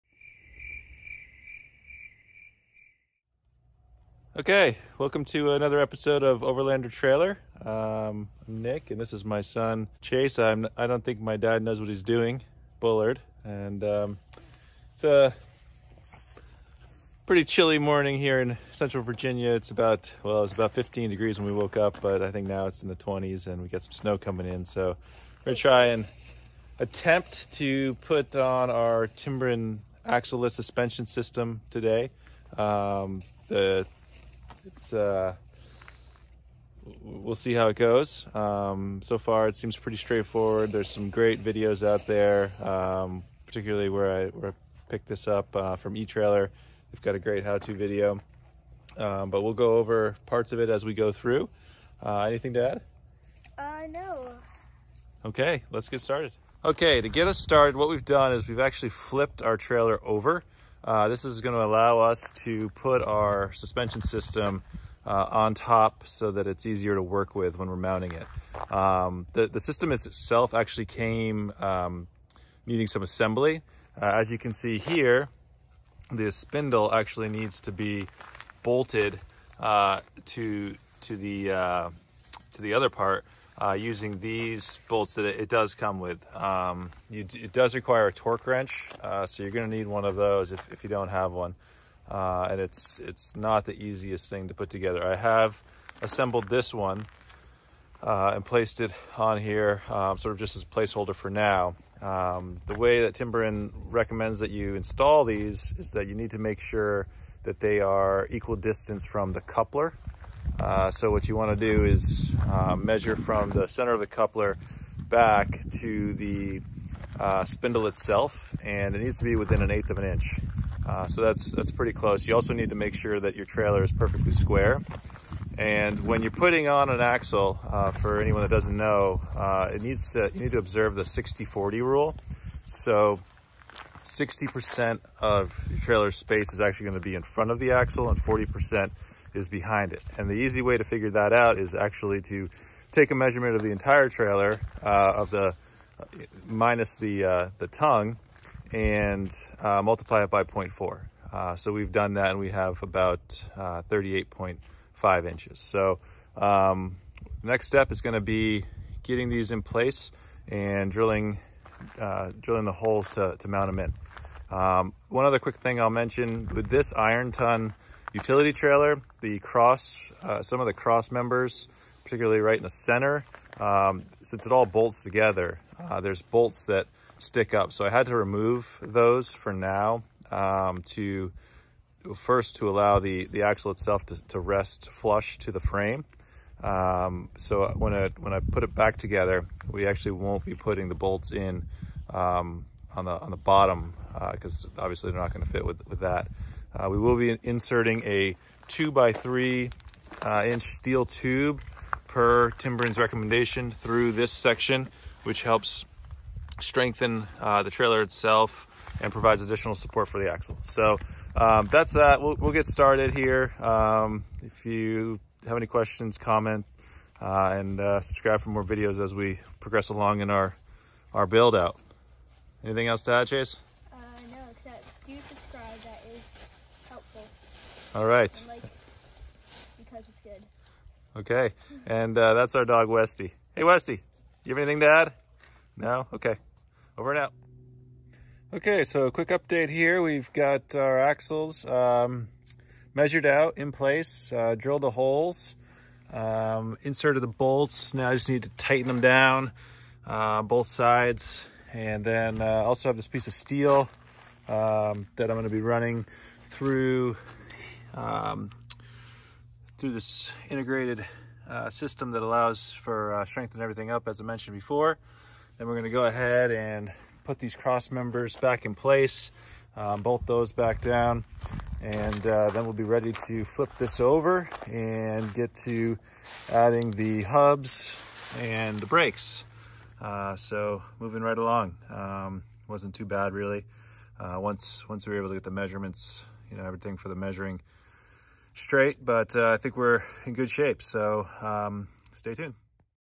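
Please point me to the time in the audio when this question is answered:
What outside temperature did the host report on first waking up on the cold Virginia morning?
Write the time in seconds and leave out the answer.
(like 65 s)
20 s.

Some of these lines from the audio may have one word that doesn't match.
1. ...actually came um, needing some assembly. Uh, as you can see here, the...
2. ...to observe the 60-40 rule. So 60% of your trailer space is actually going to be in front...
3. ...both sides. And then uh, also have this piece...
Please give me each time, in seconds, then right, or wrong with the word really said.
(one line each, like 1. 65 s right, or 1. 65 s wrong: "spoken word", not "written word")
1. 70 s right
2. 130 s right
3. 250 s right.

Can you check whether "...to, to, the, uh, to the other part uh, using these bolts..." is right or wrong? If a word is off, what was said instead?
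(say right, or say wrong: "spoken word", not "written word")
right.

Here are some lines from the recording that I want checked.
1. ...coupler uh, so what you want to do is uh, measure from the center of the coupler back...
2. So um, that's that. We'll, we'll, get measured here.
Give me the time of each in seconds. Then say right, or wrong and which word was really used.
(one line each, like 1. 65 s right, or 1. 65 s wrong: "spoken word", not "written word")
1. 109 s right
2. 210 s wrong: "started", not "measured".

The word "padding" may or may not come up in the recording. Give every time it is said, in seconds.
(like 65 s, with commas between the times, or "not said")
not said.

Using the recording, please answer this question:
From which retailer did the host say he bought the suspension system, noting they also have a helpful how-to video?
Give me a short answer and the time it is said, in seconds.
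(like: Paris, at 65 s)
eTrailer, at 45 s.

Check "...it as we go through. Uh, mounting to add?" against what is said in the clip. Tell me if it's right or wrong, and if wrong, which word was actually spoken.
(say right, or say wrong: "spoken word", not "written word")
wrong: "anything", not "mounting".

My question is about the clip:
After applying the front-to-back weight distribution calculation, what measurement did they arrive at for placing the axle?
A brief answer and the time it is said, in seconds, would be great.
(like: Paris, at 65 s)
38.5 inches, at 153 s.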